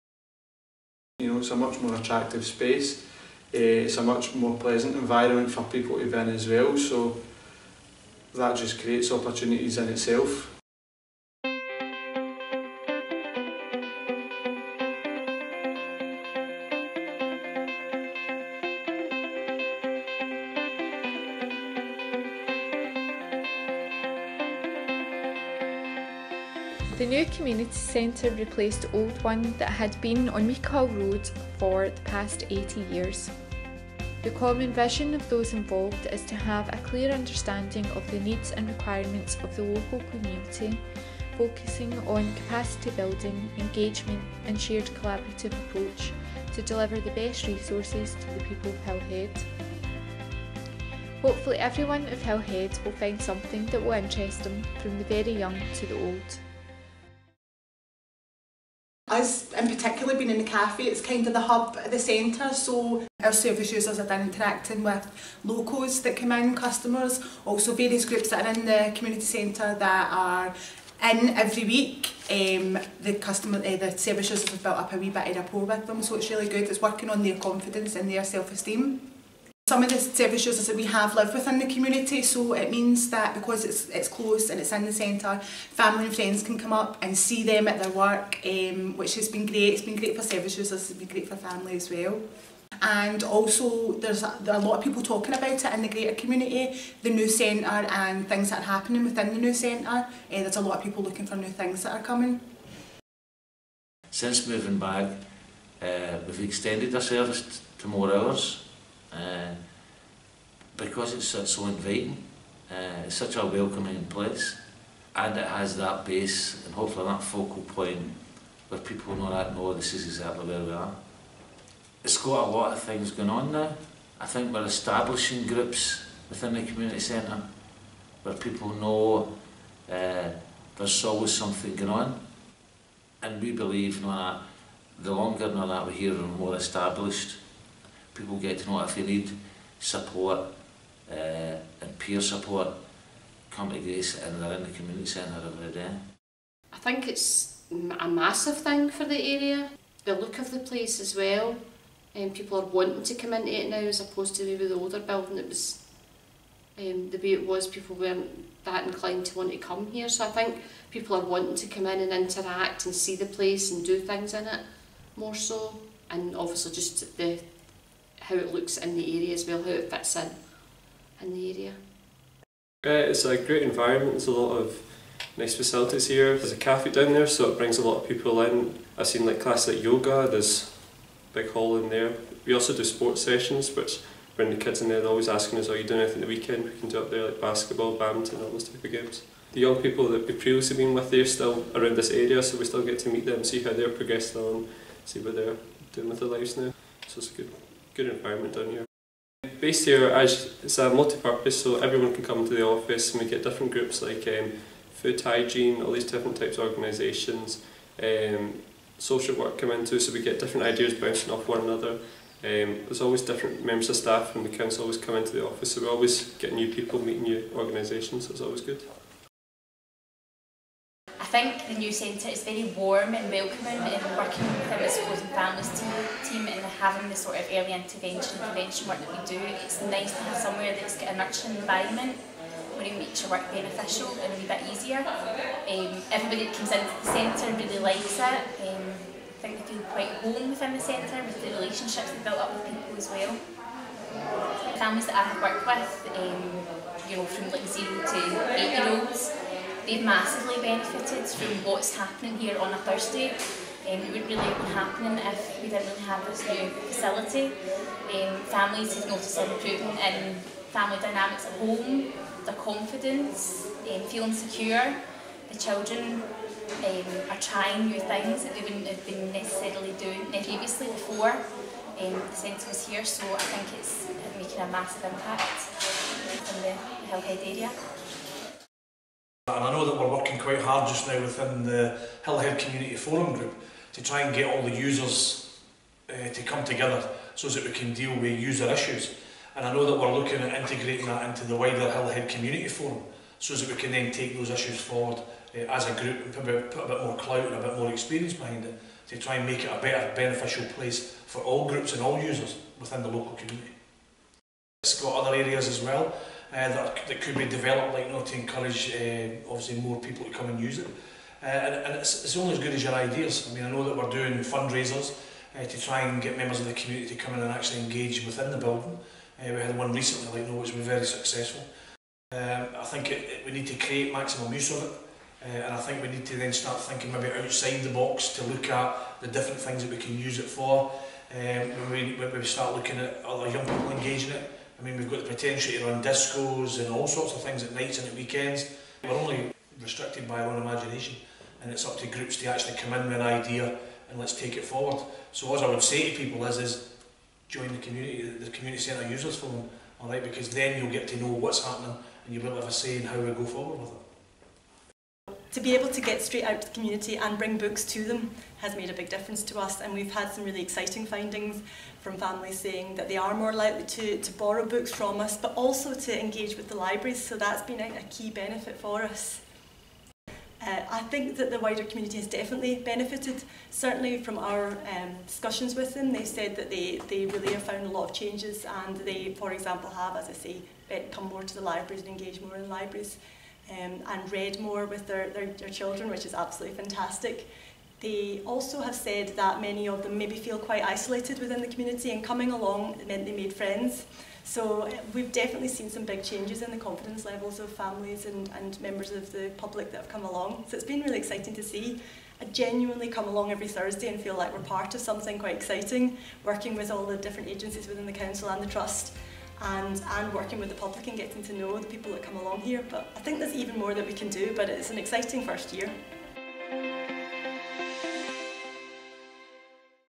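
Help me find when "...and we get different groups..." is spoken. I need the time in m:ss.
3:23.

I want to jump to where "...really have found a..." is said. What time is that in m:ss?
6:17.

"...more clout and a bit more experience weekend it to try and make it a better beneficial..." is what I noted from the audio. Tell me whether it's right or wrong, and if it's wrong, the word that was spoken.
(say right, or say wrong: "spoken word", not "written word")
wrong: "behind", not "weekend".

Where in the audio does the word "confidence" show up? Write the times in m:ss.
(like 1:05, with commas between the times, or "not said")
1:17, 4:22, 6:36.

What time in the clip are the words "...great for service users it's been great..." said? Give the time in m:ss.
1:29.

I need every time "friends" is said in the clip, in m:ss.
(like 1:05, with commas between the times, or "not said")
1:26, 6:33.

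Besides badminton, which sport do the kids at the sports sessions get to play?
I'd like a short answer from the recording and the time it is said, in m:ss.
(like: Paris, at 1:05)
Basketball, at 3:07.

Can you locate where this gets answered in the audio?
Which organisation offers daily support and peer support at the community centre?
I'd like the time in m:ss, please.
2:23.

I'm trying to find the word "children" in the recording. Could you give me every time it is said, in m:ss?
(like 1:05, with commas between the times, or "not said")
4:25, 6:25.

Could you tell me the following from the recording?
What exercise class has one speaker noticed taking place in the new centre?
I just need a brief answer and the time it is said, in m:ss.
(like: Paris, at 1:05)
Yoga, at 2:59.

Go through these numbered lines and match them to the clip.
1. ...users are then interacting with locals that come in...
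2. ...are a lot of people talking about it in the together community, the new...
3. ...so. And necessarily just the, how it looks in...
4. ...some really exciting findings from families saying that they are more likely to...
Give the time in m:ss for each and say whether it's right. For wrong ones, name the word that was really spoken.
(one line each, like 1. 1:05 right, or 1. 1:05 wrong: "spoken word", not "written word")
1. 1:03 right
2. 1:34 wrong: "greater", not "together"
3. 2:45 wrong: "obviously", not "necessarily"
4. 6:00 right.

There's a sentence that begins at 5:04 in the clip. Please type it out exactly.
It's got other areas as well.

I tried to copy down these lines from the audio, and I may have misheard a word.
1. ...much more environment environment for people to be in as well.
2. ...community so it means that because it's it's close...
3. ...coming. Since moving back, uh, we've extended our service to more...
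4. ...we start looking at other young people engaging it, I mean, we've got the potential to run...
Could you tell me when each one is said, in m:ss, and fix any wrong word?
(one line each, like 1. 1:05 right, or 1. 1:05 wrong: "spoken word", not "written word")
1. 0:04 wrong: "pleasant", not "environment"
2. 1:21 right
3. 1:42 right
4. 5:32 right.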